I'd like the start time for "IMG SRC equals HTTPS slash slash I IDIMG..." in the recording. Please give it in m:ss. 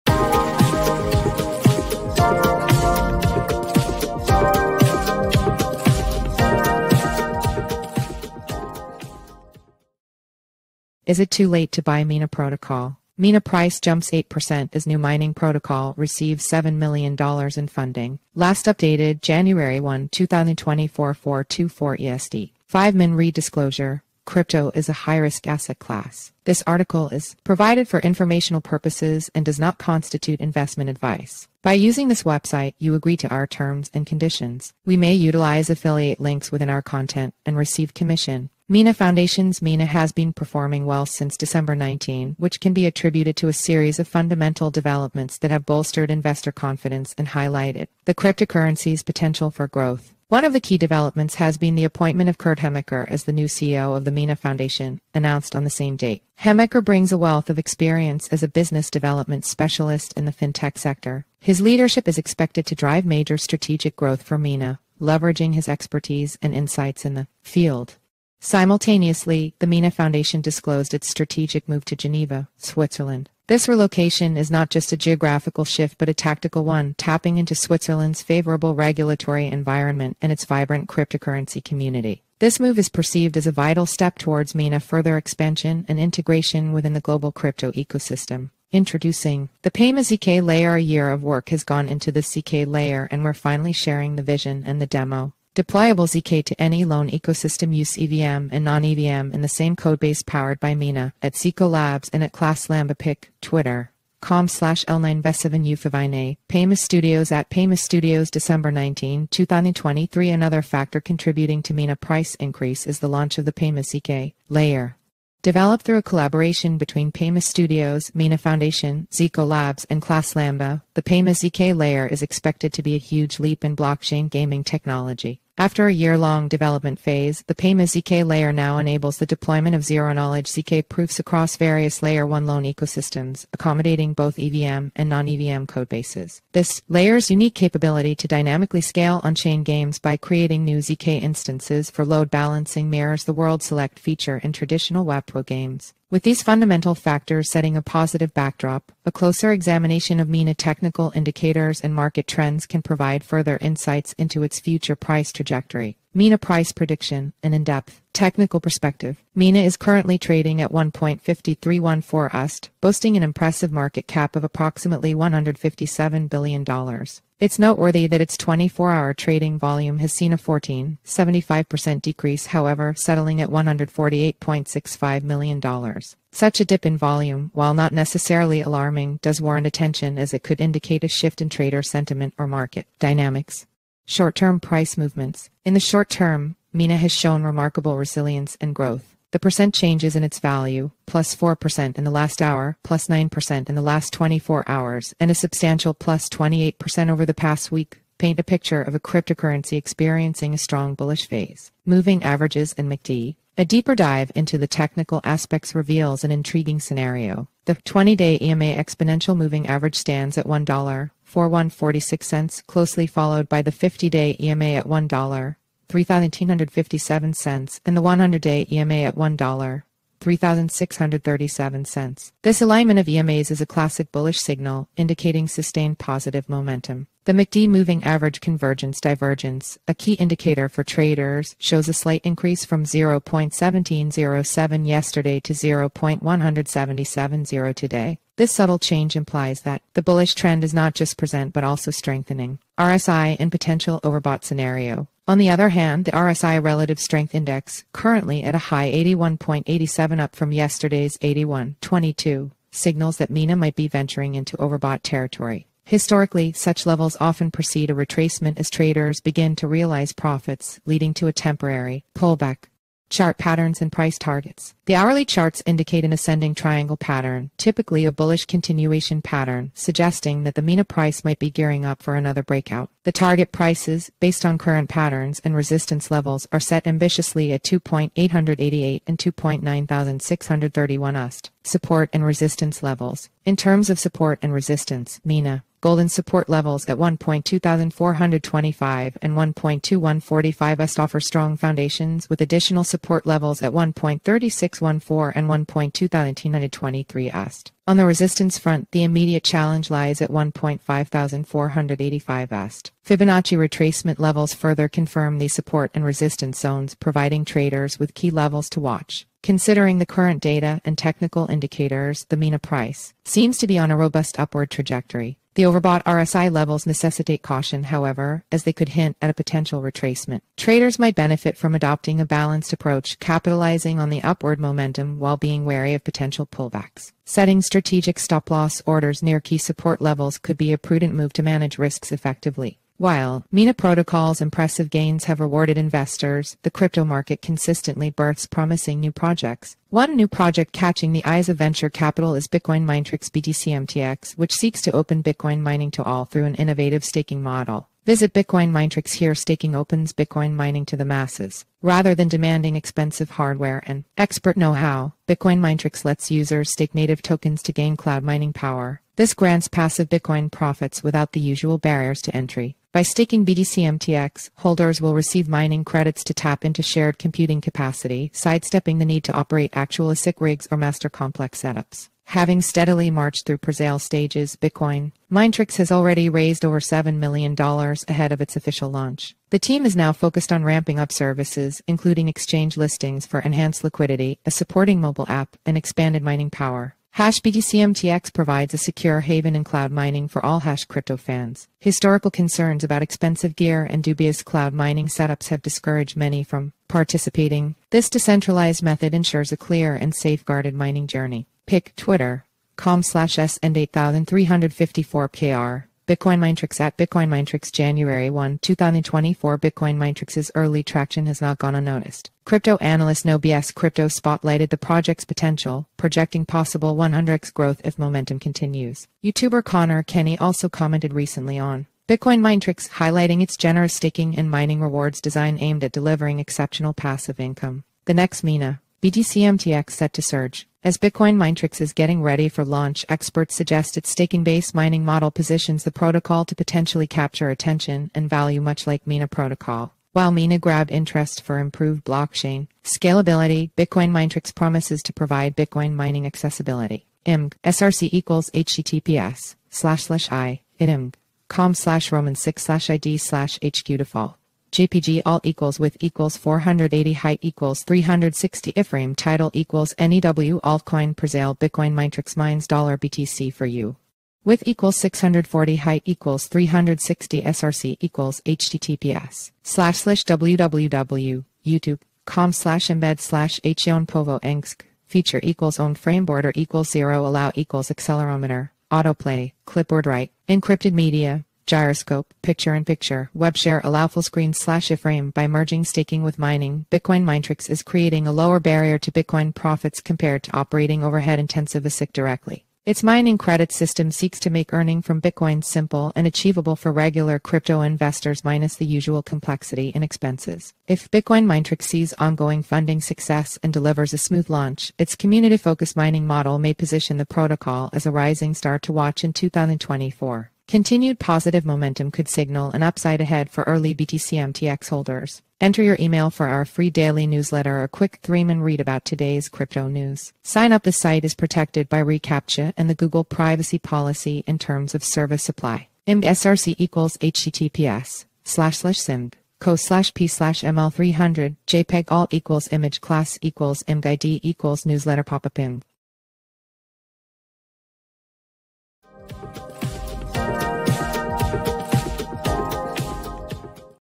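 7:27.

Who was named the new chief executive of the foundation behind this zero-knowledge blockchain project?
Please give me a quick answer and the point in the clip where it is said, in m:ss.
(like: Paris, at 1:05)
Kurt Hemecker, at 0:52.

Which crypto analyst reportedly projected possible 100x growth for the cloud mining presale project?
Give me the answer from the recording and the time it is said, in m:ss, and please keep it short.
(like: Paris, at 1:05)
No BS Crypto, at 6:53.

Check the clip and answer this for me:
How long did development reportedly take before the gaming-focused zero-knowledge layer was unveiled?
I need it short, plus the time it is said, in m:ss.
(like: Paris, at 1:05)
A year, at 1:30.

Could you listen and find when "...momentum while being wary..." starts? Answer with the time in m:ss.
5:24.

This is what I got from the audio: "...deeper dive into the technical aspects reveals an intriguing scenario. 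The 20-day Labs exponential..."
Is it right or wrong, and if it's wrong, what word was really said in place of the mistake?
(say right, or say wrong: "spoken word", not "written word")
wrong: "EMA", not "Labs".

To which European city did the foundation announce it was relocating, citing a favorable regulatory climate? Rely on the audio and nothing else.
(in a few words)
Geneva.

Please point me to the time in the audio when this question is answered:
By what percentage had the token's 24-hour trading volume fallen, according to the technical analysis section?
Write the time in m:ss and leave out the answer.
2:50.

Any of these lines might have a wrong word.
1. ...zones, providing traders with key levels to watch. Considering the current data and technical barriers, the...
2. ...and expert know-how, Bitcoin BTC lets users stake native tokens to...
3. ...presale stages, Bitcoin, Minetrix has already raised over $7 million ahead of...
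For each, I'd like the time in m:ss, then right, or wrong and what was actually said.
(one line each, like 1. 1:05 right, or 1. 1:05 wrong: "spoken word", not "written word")
1. 5:06 wrong: "indicators", not "barriers"
2. 5:53 wrong: "Minetrix", not "BTC"
3. 6:13 right.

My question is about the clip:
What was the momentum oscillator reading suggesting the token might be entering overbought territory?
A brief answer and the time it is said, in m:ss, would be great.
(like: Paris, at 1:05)
81.87, at 4:08.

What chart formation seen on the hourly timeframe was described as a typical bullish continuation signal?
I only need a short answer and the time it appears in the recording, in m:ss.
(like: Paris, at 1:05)
Ascending triangle, at 4:26.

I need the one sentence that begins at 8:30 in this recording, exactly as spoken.
Continued positive momentum could signal an upside ahead for early BTCMTX holders.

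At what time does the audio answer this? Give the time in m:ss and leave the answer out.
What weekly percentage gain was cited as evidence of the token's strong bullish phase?
3:15.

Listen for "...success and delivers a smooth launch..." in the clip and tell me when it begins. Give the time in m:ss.
8:22.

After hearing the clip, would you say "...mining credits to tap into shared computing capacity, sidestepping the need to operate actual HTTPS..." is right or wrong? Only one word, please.
wrong.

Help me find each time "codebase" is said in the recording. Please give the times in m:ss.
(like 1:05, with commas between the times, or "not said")
1:39, 2:15.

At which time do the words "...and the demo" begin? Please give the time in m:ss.
1:34.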